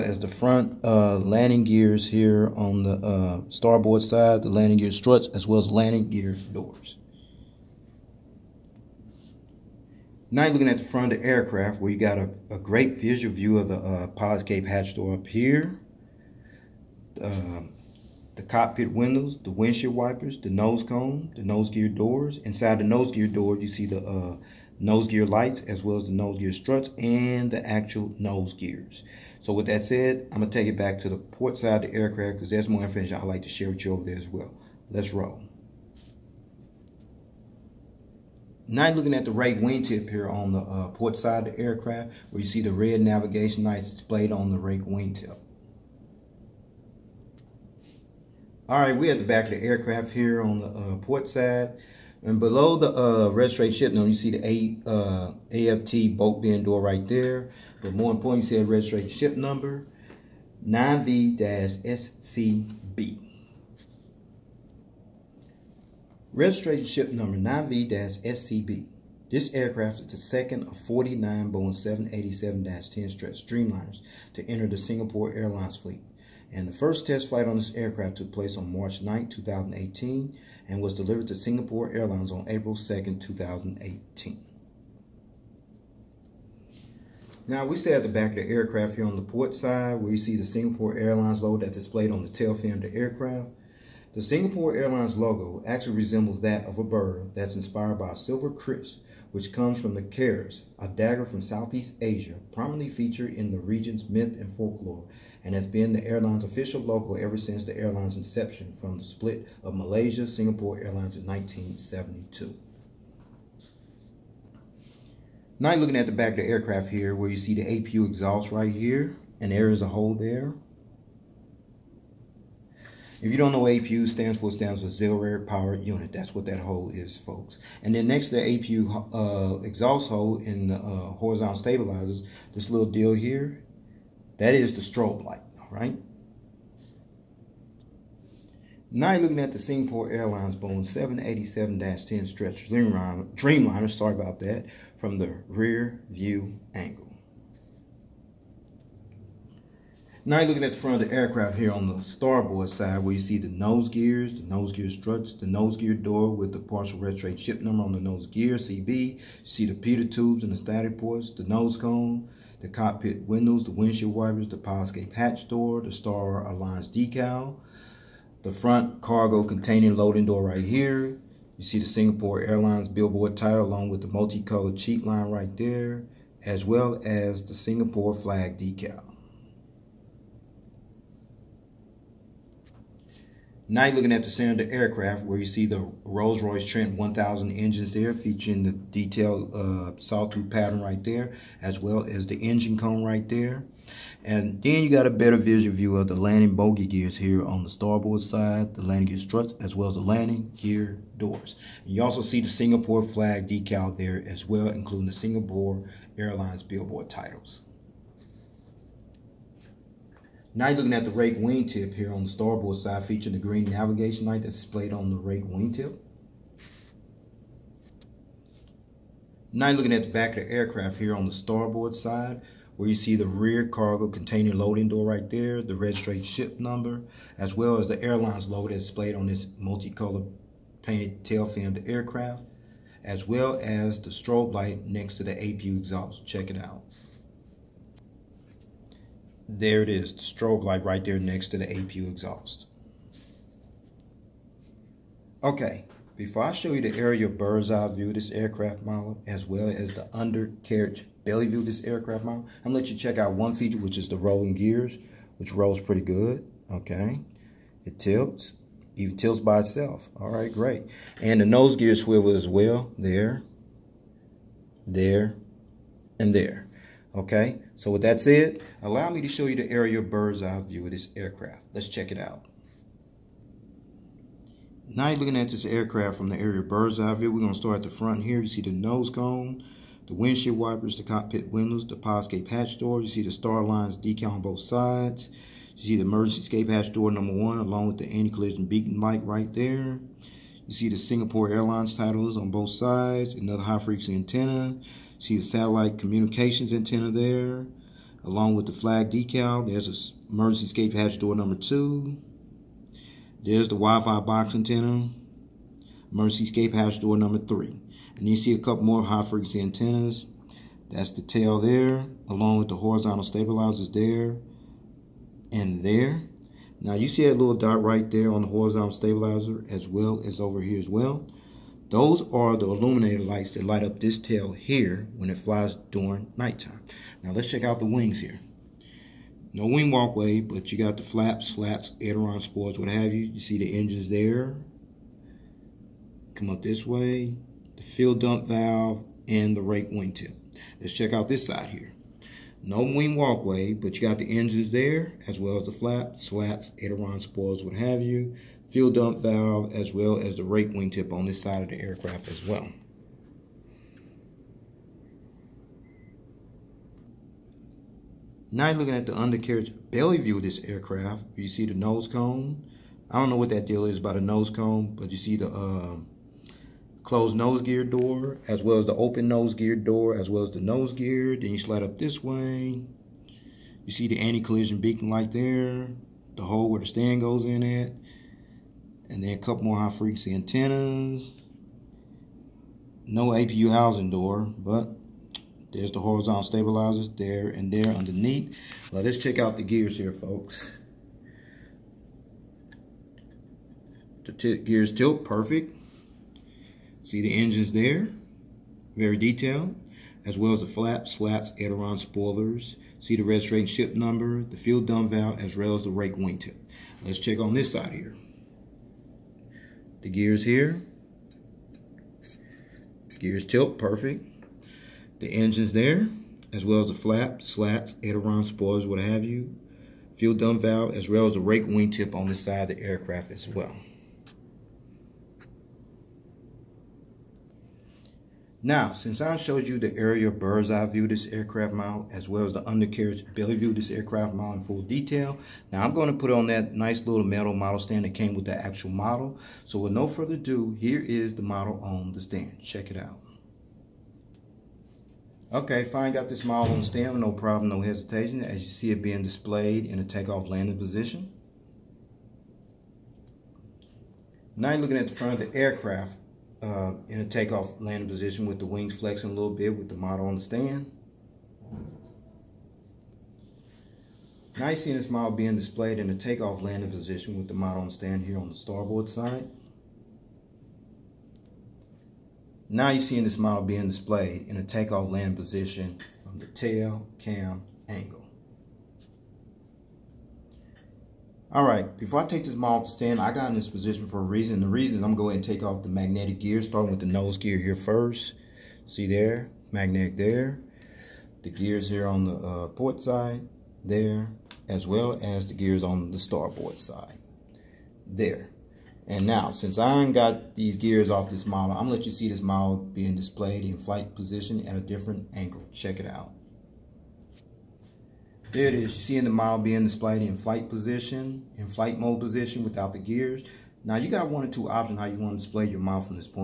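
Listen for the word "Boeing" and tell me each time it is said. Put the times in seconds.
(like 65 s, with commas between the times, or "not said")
71 s, 140 s.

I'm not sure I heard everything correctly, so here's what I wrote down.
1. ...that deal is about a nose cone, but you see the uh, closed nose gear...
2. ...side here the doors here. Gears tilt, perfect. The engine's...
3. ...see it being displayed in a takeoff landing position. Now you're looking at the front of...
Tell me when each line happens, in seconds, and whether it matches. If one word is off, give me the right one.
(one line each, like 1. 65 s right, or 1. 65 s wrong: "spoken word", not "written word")
1. 363 s right
2. 407 s wrong: "gears", not "doors"
3. 448 s right.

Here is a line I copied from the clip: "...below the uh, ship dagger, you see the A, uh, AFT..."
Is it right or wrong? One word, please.
wrong.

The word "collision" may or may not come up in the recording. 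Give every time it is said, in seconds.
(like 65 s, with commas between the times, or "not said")
288 s, 374 s.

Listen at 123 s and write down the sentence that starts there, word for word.
If you don't know what APU stands for, it stands for auxiliary power unit.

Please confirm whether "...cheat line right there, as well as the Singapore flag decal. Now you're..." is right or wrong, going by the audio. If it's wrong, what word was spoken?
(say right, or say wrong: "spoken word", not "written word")
right.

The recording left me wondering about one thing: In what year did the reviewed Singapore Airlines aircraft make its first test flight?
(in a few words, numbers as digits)
2018.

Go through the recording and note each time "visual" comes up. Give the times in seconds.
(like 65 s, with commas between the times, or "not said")
12 s, 195 s.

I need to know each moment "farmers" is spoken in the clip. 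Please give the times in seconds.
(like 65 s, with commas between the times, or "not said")
not said.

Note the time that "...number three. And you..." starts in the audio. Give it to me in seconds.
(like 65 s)
307 s.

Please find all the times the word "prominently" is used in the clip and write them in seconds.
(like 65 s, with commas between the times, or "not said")
102 s.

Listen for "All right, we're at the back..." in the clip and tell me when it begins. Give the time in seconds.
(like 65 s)
48 s.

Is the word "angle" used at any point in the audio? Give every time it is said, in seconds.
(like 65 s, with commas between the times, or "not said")
146 s, 477 s, 505 s.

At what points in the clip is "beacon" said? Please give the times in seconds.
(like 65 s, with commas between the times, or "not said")
288 s, 374 s.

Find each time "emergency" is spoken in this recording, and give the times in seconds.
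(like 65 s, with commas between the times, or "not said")
286 s, 300 s, 306 s.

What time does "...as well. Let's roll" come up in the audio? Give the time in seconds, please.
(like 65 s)
34 s.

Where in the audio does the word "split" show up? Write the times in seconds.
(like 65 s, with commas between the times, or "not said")
109 s.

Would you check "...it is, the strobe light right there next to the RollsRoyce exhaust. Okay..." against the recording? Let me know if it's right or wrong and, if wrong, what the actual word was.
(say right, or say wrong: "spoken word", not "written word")
wrong: "APU", not "RollsRoyce".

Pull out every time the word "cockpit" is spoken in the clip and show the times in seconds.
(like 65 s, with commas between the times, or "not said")
18 s, 162 s, 281 s.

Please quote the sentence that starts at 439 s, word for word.
So with no further ado, here is the model on the stand.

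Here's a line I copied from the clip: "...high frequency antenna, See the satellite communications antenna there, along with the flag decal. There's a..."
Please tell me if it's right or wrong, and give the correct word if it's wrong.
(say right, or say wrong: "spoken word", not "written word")
right.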